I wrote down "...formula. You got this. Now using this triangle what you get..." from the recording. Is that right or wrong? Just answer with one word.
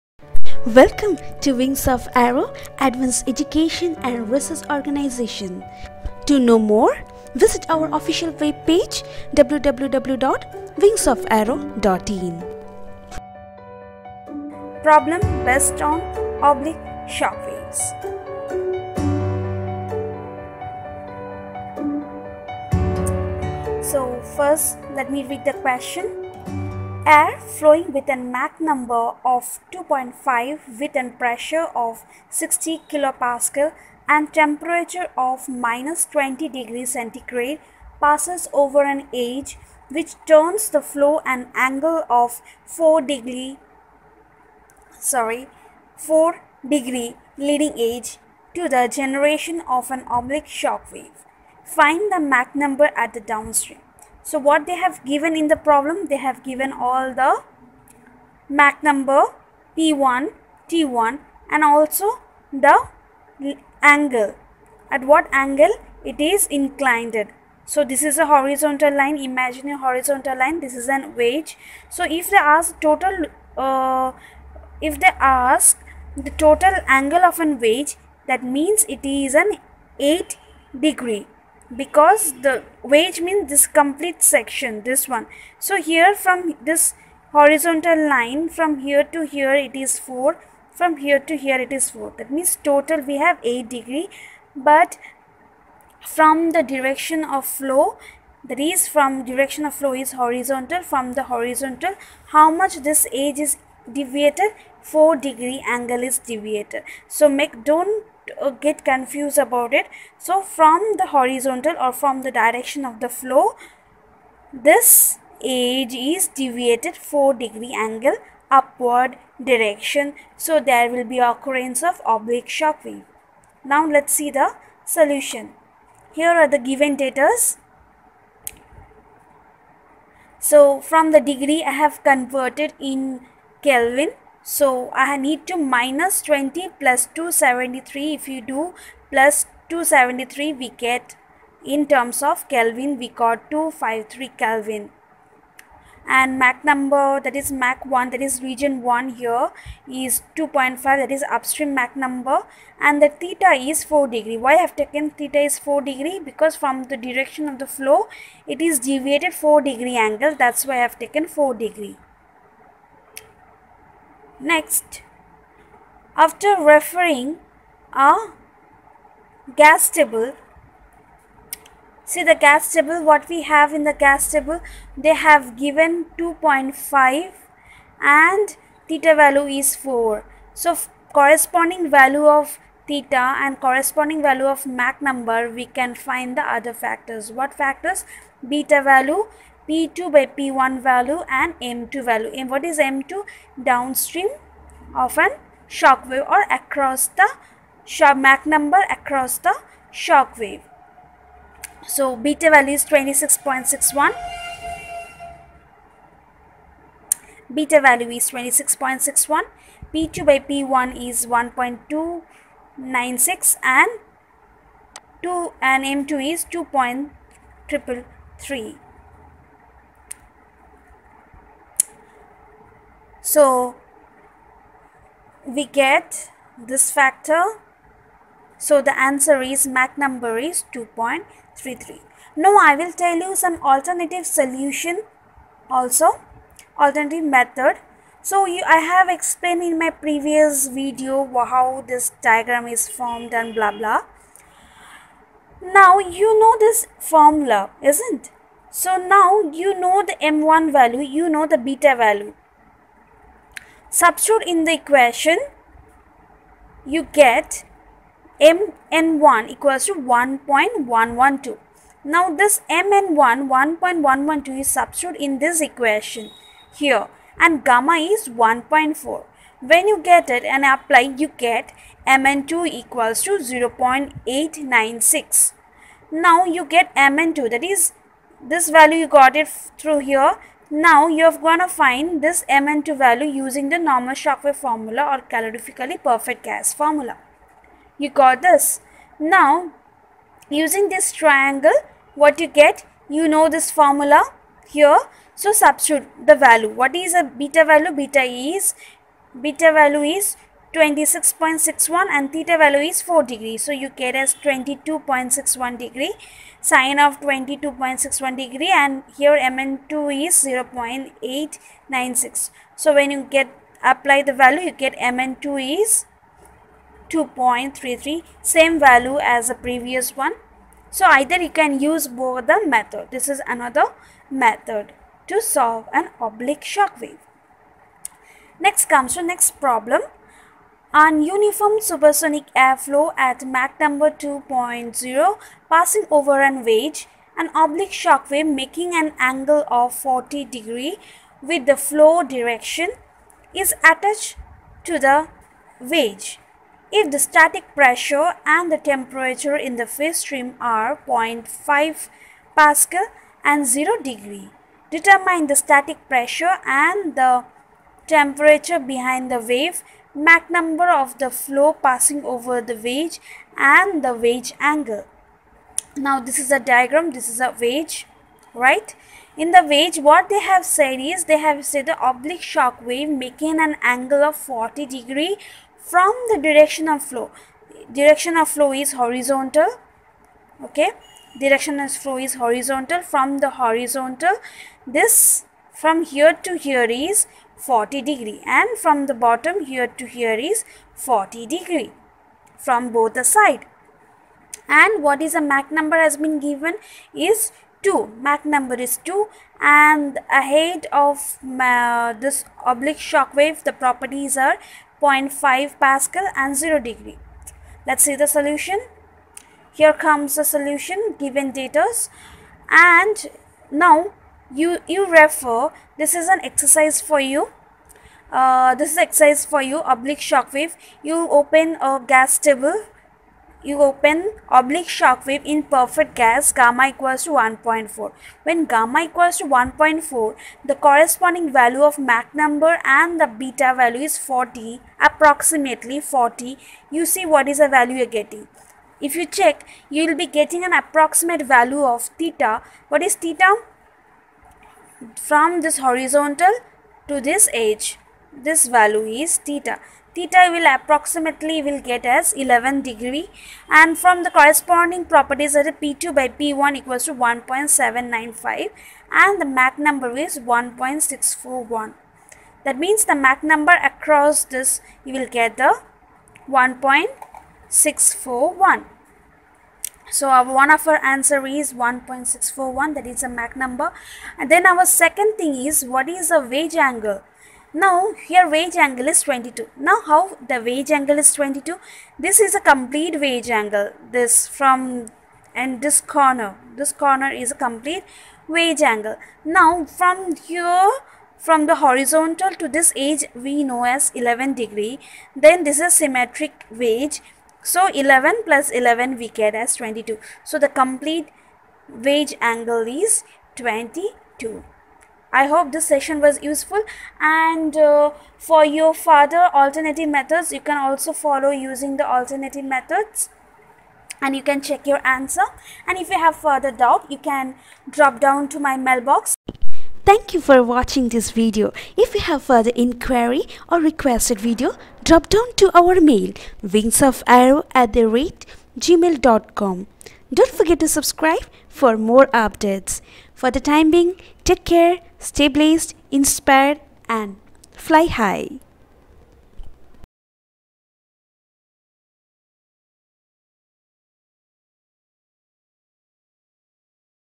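right.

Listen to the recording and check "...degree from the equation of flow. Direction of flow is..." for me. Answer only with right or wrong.
wrong.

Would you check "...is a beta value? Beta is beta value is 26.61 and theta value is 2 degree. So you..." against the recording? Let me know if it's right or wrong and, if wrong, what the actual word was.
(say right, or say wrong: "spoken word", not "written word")
wrong: "4", not "2".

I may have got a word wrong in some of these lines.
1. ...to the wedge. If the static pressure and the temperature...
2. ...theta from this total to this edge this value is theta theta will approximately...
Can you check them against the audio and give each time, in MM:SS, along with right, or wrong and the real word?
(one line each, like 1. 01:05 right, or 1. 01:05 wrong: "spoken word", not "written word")
1. 05:44 right
2. 07:23 wrong: "horizontal", not "total".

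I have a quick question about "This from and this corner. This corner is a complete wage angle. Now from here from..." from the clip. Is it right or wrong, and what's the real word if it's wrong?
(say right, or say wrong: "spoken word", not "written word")
right.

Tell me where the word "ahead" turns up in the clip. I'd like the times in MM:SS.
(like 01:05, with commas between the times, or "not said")
06:40.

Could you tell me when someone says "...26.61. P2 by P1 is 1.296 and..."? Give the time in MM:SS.
03:28.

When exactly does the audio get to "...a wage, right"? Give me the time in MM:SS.
06:07.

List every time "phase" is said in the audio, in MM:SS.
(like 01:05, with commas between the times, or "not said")
05:49.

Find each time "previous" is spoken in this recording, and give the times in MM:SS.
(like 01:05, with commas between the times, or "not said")
03:59, 05:19.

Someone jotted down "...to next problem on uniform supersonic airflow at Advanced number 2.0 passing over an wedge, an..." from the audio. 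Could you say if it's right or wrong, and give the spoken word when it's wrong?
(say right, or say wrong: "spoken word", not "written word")
wrong: "Mach", not "Advanced".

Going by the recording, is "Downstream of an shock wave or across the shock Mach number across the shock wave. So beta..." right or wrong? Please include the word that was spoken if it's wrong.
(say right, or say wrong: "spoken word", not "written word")
right.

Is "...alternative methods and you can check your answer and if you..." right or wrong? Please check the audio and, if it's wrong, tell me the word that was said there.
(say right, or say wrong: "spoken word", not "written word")
right.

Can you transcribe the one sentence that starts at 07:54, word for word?
And then our second thing is what is a wage angle?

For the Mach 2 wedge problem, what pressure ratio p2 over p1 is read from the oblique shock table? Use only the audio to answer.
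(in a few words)
1.795.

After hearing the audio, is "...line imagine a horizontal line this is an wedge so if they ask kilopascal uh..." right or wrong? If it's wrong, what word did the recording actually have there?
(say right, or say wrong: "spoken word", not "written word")
wrong: "total", not "kilopascal".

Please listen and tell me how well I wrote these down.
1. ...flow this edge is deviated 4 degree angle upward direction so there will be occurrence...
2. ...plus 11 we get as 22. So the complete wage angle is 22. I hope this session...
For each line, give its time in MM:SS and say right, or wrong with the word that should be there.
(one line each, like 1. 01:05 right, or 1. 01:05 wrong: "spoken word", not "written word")
1. 01:53 right
2. 08:18 right.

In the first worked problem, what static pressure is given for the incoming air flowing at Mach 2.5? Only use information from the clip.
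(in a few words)
60 kilopascal.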